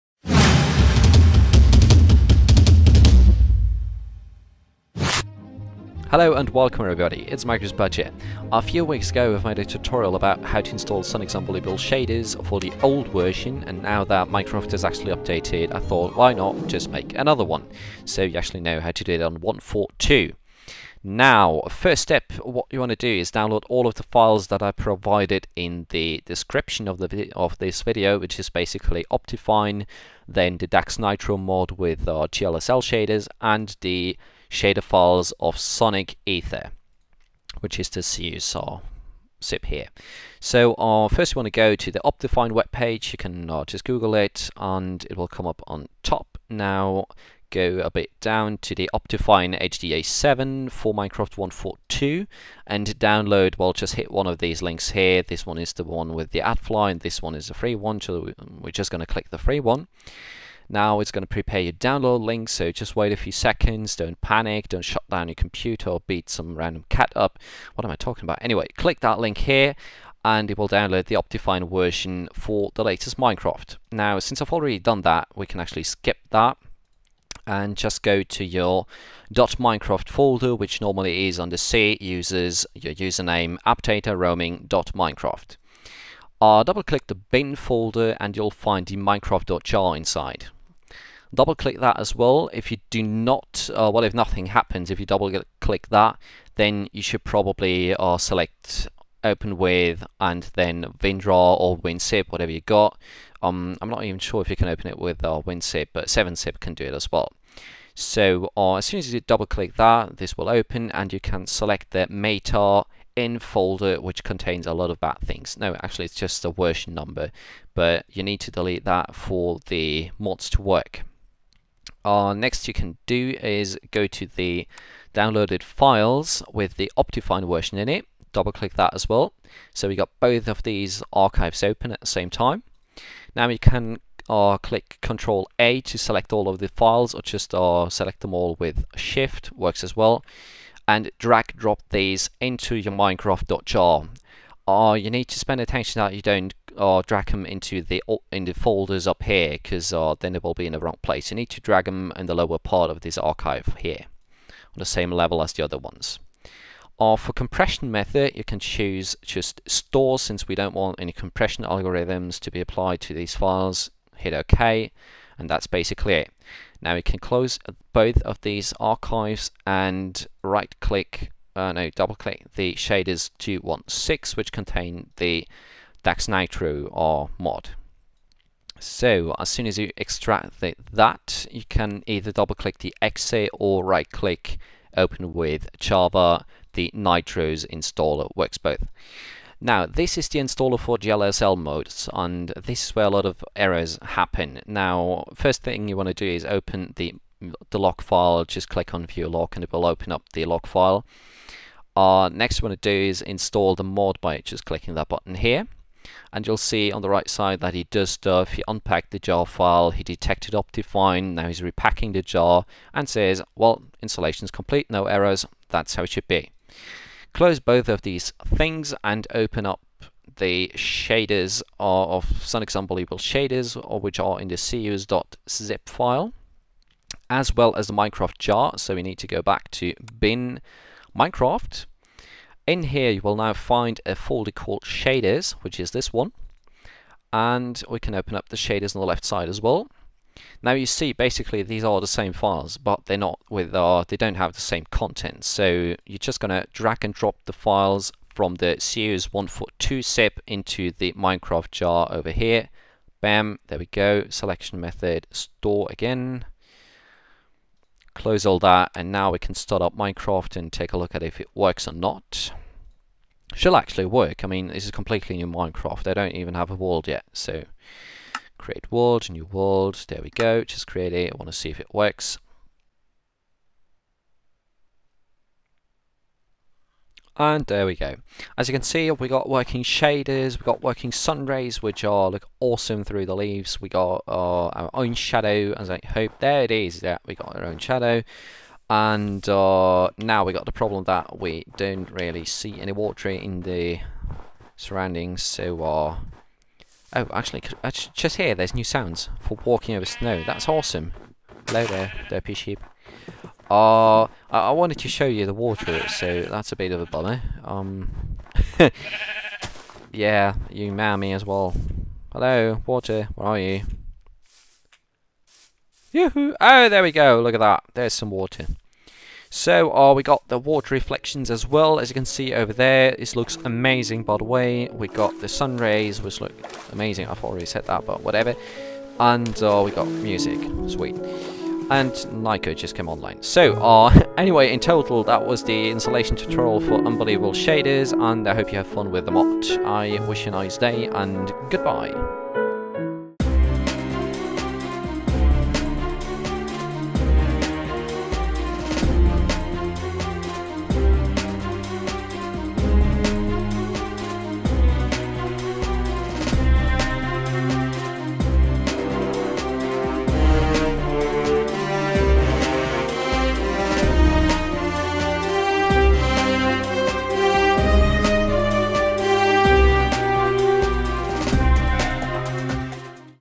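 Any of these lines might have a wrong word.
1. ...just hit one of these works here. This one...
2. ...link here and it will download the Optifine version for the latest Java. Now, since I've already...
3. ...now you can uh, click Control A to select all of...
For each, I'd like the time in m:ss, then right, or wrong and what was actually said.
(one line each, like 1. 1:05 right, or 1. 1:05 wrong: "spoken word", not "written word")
1. 0:53 wrong: "links", not "works"
2. 1:09 wrong: "Minecraft", not "Java"
3. 2:13 right.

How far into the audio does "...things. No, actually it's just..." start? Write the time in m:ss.
1:55.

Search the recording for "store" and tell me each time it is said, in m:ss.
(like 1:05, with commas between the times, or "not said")
2:39, 4:15.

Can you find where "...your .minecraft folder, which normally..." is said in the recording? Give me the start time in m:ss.
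1:18.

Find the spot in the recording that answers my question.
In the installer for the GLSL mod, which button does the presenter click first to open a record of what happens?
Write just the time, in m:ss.
3:19.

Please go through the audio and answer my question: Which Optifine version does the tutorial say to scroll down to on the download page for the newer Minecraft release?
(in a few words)
HDA7.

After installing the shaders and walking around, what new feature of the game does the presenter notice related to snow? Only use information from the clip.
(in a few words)
new sounds.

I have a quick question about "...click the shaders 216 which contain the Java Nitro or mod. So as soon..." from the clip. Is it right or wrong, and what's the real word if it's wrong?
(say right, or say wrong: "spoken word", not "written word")
wrong: "DAX", not "Java".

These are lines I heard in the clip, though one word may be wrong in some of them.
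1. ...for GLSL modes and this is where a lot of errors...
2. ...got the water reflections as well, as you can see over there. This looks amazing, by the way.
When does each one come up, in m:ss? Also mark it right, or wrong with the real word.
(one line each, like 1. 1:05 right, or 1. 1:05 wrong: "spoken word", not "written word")
1. 3:10 right
2. 5:20 right.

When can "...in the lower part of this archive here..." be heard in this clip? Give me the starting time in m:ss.
2:32.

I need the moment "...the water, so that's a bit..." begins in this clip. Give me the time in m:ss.
5:05.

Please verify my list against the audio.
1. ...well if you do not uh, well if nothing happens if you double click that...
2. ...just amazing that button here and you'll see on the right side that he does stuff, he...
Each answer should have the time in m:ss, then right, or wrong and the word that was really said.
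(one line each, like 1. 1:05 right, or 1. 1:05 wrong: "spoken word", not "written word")
1. 1:32 right
2. 3:24 wrong: "clicking", not "amazing".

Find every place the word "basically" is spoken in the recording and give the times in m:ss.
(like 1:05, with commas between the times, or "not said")
0:28, 2:45, 4:01.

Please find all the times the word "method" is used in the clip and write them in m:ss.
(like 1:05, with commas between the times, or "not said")
2:37, 4:14.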